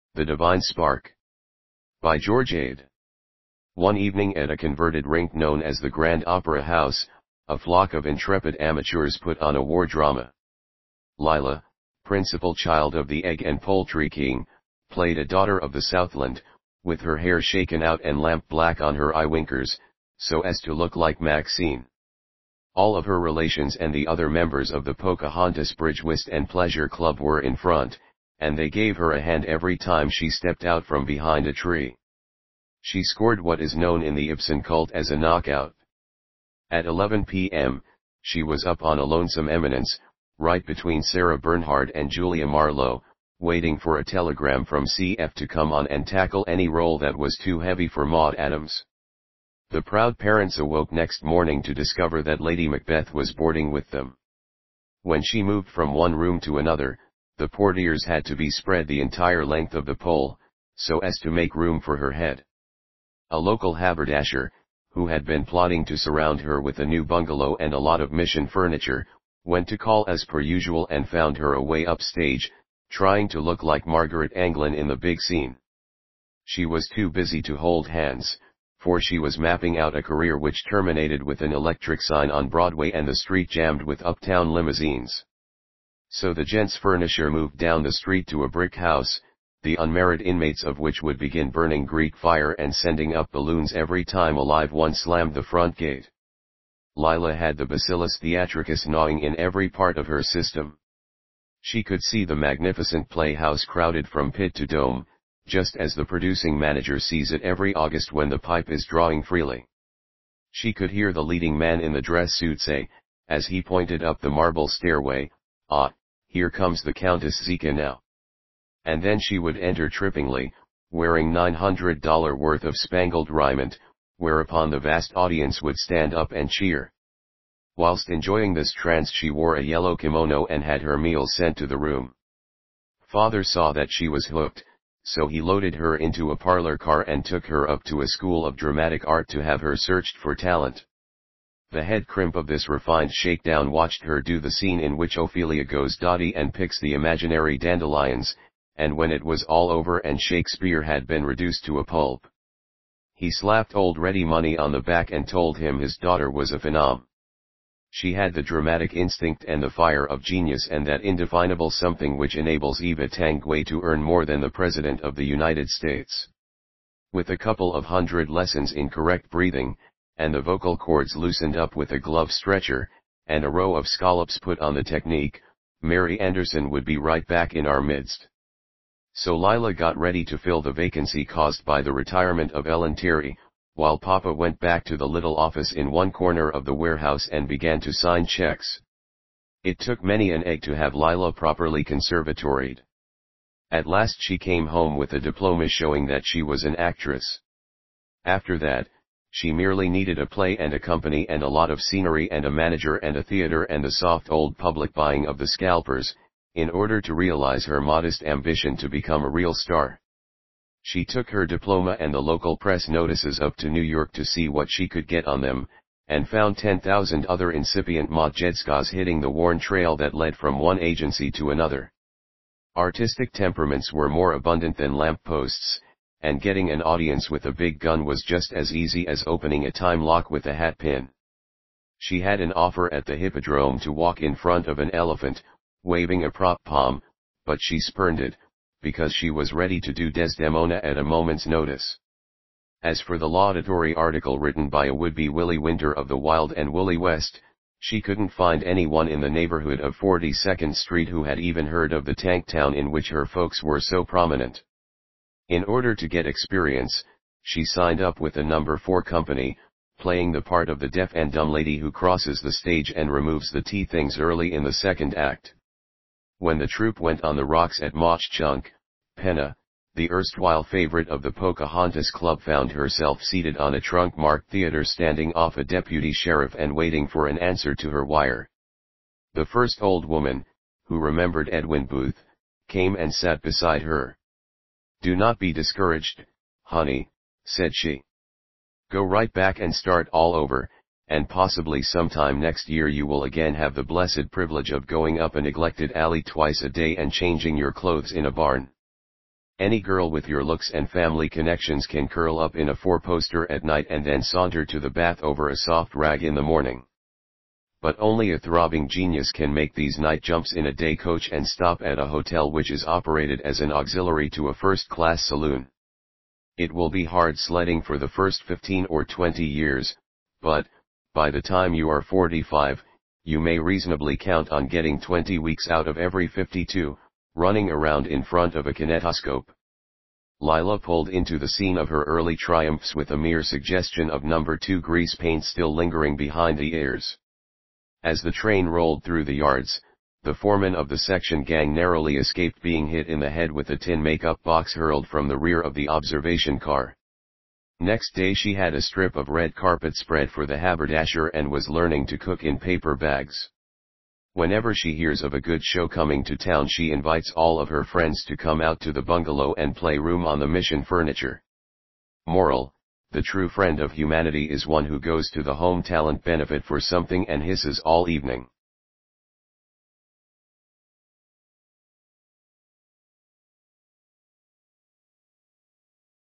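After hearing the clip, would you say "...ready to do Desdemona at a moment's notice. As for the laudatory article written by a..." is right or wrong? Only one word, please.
right.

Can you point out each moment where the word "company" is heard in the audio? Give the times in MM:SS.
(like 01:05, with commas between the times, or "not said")
03:20, 04:19.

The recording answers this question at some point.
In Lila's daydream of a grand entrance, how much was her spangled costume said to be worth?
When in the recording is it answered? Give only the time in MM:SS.
02:01.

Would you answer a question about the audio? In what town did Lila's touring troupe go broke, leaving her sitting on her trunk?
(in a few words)
Mauch Chunk.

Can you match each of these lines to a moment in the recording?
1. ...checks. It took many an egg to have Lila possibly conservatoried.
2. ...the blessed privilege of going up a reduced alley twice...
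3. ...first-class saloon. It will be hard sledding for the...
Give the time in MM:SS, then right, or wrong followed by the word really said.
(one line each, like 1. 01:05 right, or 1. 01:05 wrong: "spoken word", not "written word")
1. 03:08 wrong: "properly", not "possibly"
2. 04:53 wrong: "neglected", not "reduced"
3. 05:14 right.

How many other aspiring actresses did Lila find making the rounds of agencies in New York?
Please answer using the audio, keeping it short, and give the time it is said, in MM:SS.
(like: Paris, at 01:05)
10,000, at 03:36.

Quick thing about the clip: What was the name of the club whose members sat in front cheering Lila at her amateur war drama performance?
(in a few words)
Pocahontas Bridge Whist and Pleasure Club.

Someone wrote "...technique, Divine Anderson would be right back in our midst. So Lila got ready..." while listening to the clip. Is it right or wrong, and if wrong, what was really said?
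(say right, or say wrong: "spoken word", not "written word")
wrong: "Mary", not "Divine".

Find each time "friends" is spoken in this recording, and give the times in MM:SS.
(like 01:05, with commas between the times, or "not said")
05:57, 06:03.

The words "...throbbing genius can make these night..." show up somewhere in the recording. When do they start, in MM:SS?
05:08.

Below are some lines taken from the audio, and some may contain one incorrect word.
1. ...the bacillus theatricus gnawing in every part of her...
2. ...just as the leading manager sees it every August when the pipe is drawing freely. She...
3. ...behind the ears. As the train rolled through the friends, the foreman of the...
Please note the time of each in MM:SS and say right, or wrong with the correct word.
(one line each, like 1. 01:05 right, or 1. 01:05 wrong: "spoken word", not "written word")
1. 01:37 right
2. 01:45 wrong: "producing", not "leading"
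3. 05:36 wrong: "yards", not "friends".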